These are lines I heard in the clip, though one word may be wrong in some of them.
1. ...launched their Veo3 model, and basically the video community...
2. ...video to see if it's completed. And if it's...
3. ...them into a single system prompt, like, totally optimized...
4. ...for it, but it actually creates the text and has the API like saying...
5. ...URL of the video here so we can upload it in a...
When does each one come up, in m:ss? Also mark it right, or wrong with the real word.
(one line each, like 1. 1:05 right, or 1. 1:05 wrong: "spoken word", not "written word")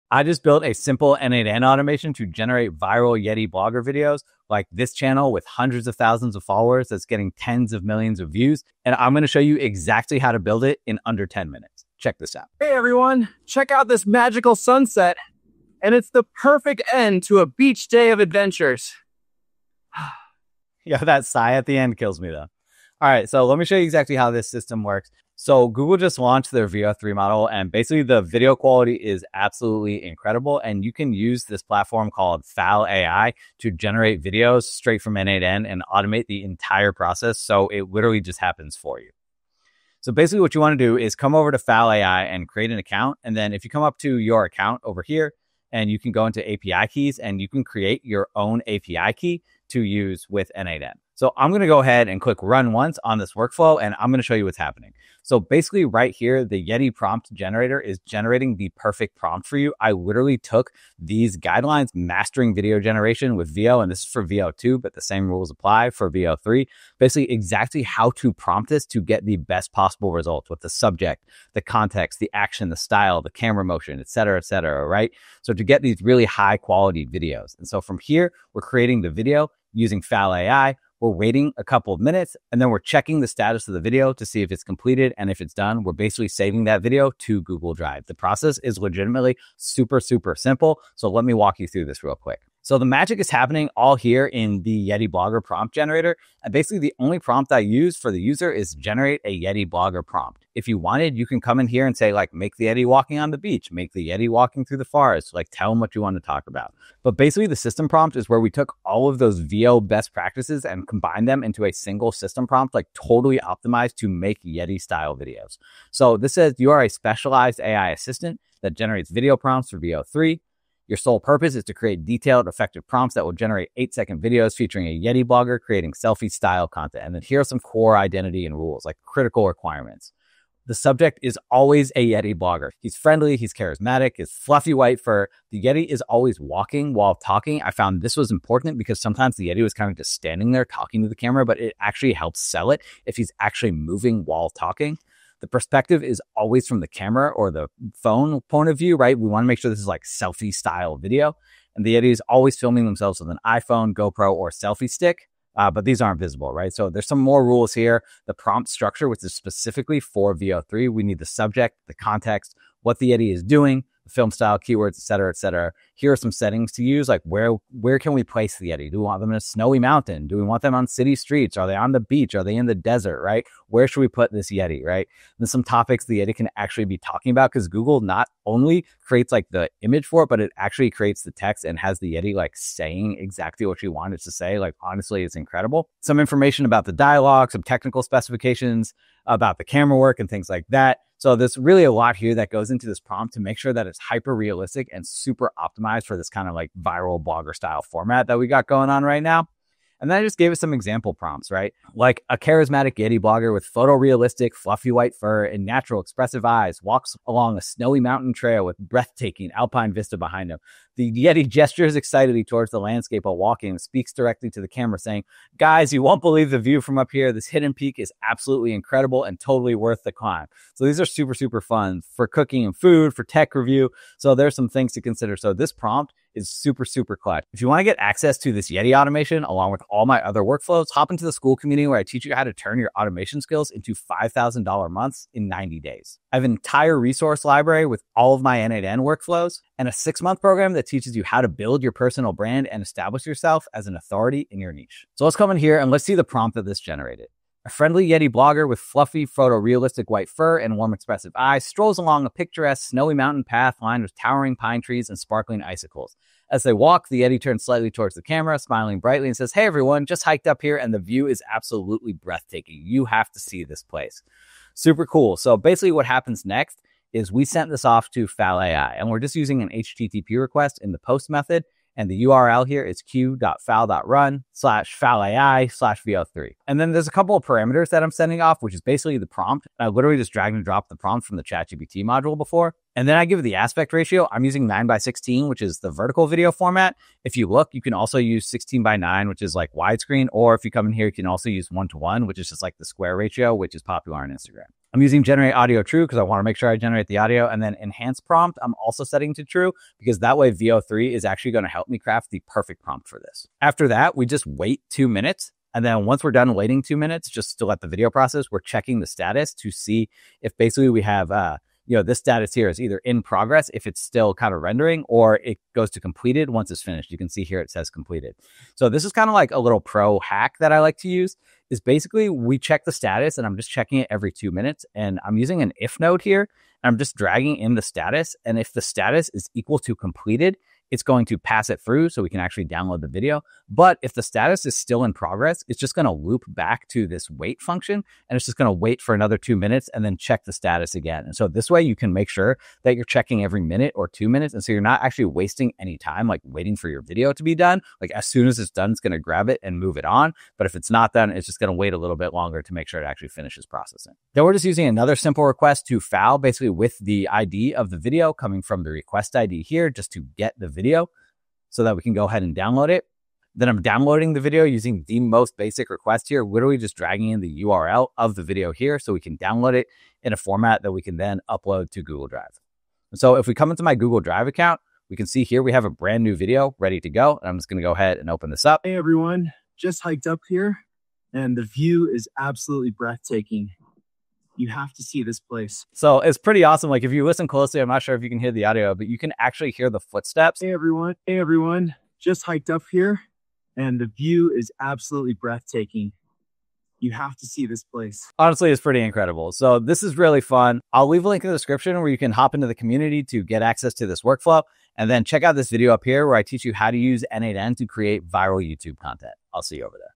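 1. 0:26 wrong: "quality", not "community"
2. 1:23 right
3. 1:51 right
4. 3:00 wrong: "Yeti", not "API"
5. 6:07 wrong: "download", not "upload".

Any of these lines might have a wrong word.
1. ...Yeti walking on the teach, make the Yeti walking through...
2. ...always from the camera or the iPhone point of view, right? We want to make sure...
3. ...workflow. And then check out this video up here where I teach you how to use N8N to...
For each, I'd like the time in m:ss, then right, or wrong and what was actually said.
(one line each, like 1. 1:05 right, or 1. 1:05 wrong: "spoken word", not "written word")
1. 1:42 wrong: "beach", not "teach"
2. 2:26 wrong: "phone", not "iPhone"
3. 6:44 right.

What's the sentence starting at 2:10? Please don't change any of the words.
The subject is always a Yeti blogger.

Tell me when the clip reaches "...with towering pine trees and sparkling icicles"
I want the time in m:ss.
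4:14.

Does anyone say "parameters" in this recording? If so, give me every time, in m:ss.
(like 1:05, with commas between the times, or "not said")
4:37.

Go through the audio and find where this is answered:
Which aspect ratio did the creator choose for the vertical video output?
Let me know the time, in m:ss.
4:44.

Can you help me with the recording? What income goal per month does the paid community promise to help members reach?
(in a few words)
$5,000.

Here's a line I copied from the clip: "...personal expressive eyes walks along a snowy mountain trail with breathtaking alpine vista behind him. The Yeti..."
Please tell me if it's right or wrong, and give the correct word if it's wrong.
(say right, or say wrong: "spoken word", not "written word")
wrong: "natural", not "personal".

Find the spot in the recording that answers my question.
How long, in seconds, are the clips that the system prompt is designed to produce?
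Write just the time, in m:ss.
2:03.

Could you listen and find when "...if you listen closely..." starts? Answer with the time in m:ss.
6:27.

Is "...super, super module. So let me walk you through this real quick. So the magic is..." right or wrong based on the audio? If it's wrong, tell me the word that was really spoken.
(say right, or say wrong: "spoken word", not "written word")
wrong: "simple", not "module".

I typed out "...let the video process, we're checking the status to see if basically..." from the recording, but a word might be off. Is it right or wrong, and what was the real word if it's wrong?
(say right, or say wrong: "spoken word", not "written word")
right.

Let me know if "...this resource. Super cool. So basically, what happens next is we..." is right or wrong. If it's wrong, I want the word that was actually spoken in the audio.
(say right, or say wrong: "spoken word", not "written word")
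wrong: "place", not "resource".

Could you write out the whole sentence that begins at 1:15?
So to get these really high quality videos.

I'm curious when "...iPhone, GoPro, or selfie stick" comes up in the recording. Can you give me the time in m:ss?
2:33.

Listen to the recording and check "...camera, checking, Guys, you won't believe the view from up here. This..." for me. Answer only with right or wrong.
wrong.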